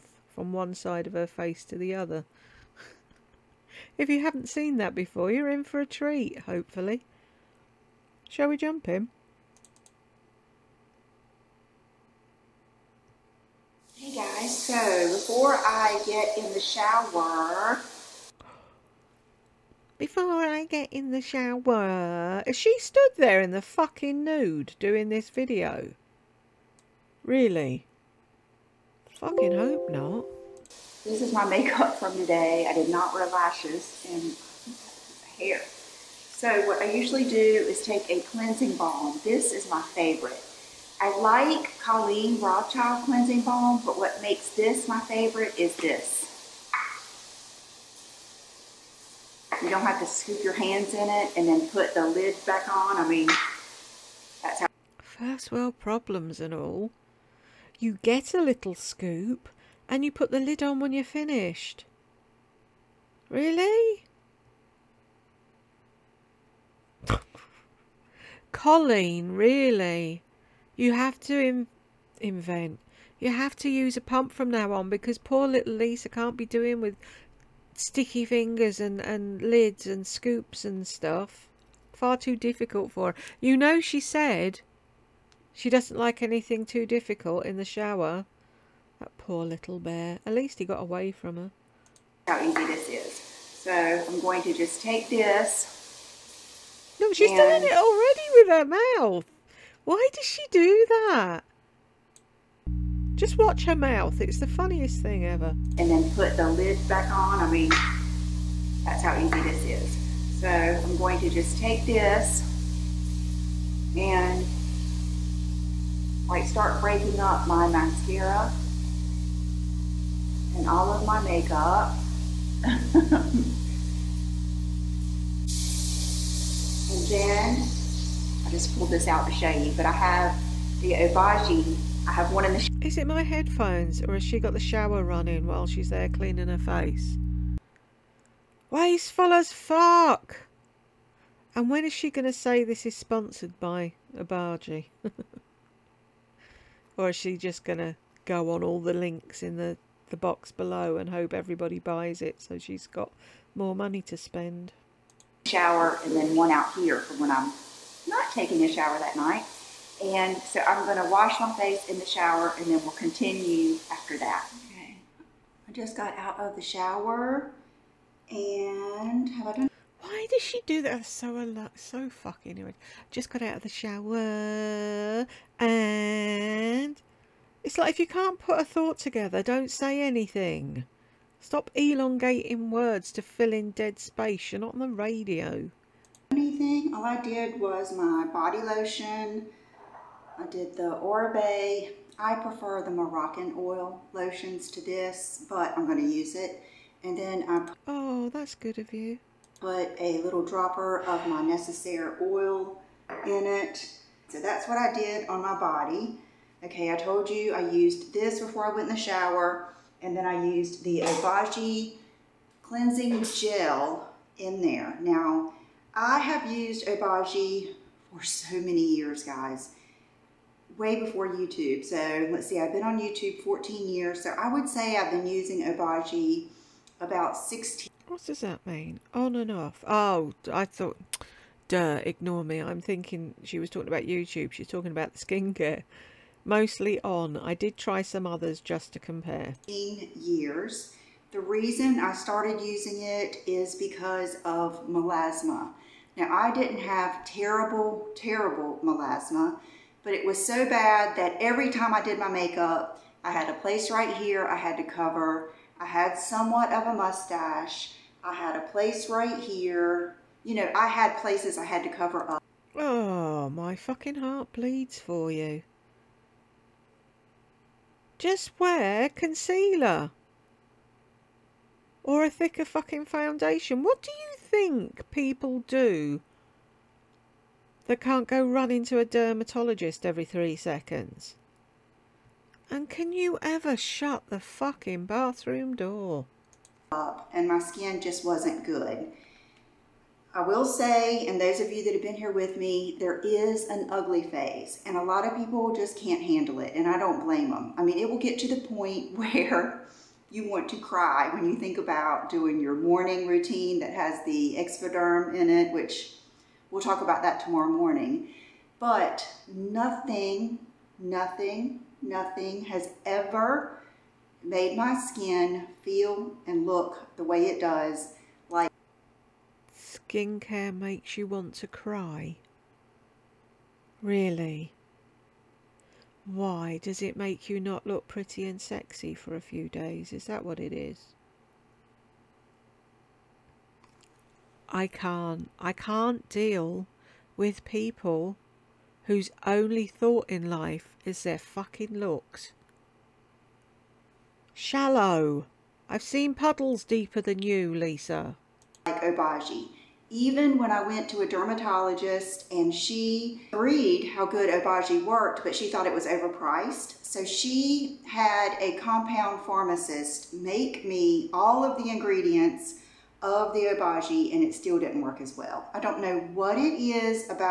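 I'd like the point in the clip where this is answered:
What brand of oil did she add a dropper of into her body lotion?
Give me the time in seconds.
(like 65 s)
201 s.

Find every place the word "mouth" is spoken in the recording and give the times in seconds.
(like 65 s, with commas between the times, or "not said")
99 s, 103 s.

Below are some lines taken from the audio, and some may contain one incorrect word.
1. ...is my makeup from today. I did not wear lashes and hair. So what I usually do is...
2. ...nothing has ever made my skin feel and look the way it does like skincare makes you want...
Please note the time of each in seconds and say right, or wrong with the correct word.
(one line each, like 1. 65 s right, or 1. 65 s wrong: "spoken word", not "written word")
1. 31 s right
2. 312 s right.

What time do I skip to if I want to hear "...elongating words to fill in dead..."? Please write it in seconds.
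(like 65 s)
181 s.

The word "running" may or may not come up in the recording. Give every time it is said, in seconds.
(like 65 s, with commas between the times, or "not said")
135 s, 278 s.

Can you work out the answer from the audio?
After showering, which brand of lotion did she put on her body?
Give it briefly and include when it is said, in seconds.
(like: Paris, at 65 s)
Oribe, at 190 s.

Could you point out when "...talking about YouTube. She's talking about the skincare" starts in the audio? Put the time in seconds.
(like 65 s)
233 s.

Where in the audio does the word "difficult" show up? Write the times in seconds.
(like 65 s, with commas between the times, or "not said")
82 s, 86 s.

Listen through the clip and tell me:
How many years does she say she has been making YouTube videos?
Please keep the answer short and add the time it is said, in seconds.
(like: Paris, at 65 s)
14 years, at 223 s.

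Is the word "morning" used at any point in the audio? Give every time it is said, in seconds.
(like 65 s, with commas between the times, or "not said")
302 s, 307 s.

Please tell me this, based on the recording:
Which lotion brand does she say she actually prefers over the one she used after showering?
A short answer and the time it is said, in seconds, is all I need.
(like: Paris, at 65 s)
Moroccan oil, at 192 s.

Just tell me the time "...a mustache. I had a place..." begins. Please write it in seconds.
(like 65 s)
256 s.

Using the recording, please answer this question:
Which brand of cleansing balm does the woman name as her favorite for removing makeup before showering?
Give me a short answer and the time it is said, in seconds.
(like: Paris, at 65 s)
Colleen Rothschild, at 41 s.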